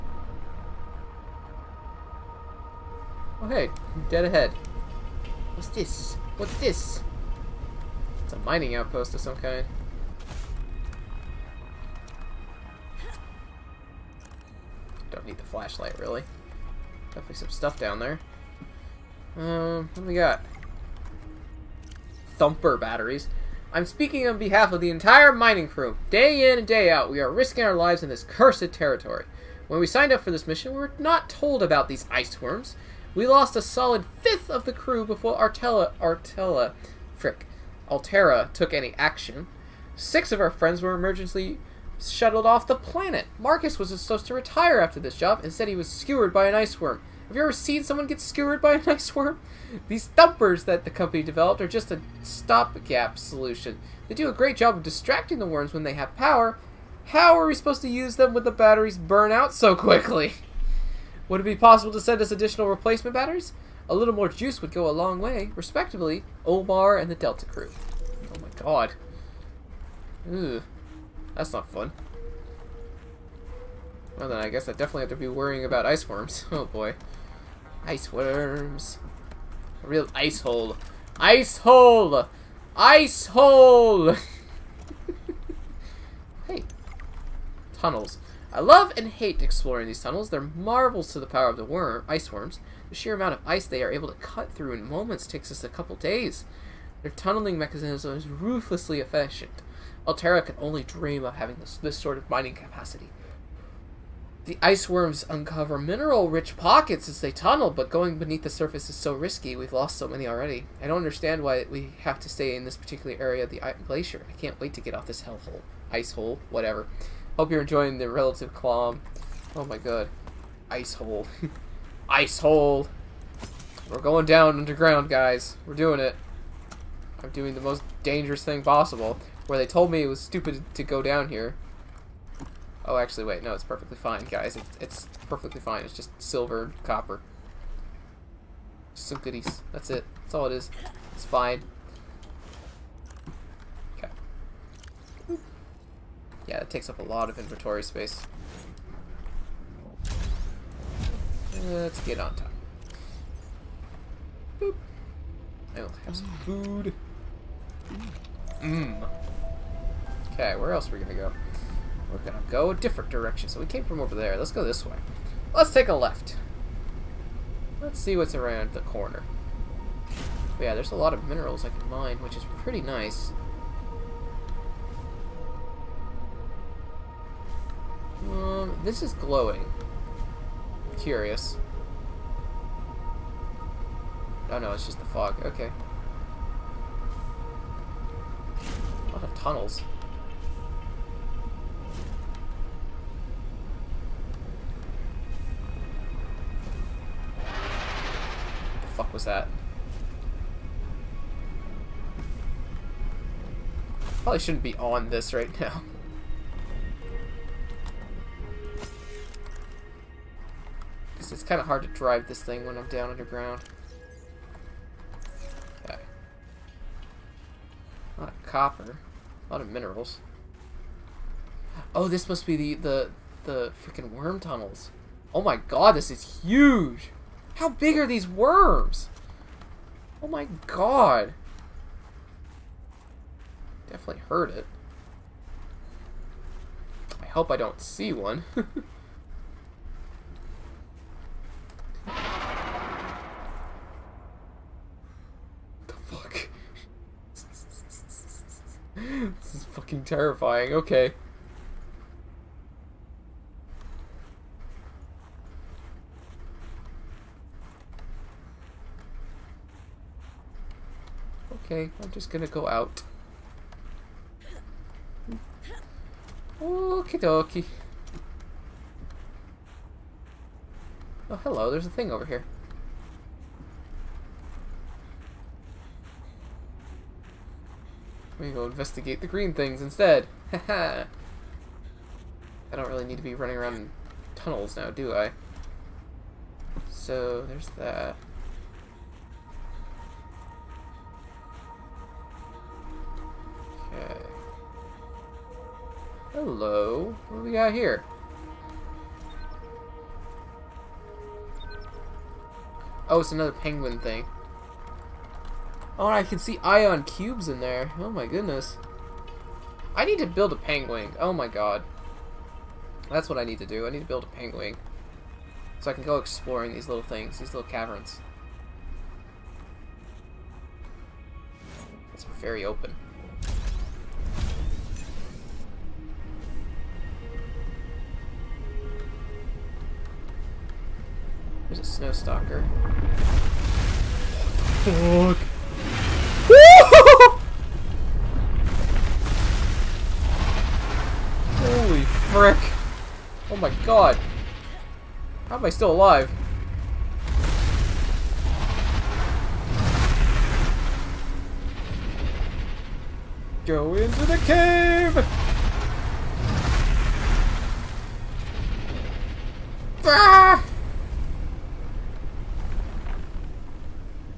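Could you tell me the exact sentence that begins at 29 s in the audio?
When we signed up for this mission, we were not told about these ice worms.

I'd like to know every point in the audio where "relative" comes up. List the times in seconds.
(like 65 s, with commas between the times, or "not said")
118 s.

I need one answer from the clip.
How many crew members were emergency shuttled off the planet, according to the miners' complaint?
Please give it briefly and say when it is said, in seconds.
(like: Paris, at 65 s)
6, at 39 s.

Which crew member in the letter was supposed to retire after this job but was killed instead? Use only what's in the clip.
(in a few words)
Marcus.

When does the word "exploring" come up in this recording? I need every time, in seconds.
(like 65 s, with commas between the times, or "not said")
89 s, 316 s.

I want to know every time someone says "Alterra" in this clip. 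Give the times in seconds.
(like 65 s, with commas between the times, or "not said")
37 s, 100 s.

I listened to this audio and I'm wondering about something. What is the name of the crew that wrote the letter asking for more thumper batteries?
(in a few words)
Delta crew.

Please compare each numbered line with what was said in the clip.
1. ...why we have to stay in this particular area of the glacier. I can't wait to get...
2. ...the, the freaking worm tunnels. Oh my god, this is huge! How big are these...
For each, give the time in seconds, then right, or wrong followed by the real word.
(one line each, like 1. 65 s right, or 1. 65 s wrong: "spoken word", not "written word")
1. 111 s right
2. 222 s right.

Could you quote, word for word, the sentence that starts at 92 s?
The sheer amount of ice they are able to cut through in moments takes us a couple days.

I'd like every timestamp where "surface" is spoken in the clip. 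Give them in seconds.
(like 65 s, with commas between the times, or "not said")
108 s.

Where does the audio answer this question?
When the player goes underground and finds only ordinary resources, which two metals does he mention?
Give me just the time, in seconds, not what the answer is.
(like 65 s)
136 s.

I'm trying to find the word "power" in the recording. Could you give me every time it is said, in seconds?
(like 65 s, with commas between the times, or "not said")
56 s, 91 s.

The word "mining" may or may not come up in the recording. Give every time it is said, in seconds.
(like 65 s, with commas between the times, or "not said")
8 s, 25 s, 102 s.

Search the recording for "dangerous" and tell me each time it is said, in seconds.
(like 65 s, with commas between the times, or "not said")
128 s.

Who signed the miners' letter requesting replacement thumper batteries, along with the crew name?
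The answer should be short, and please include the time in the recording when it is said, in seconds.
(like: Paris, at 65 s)
Omar, at 66 s.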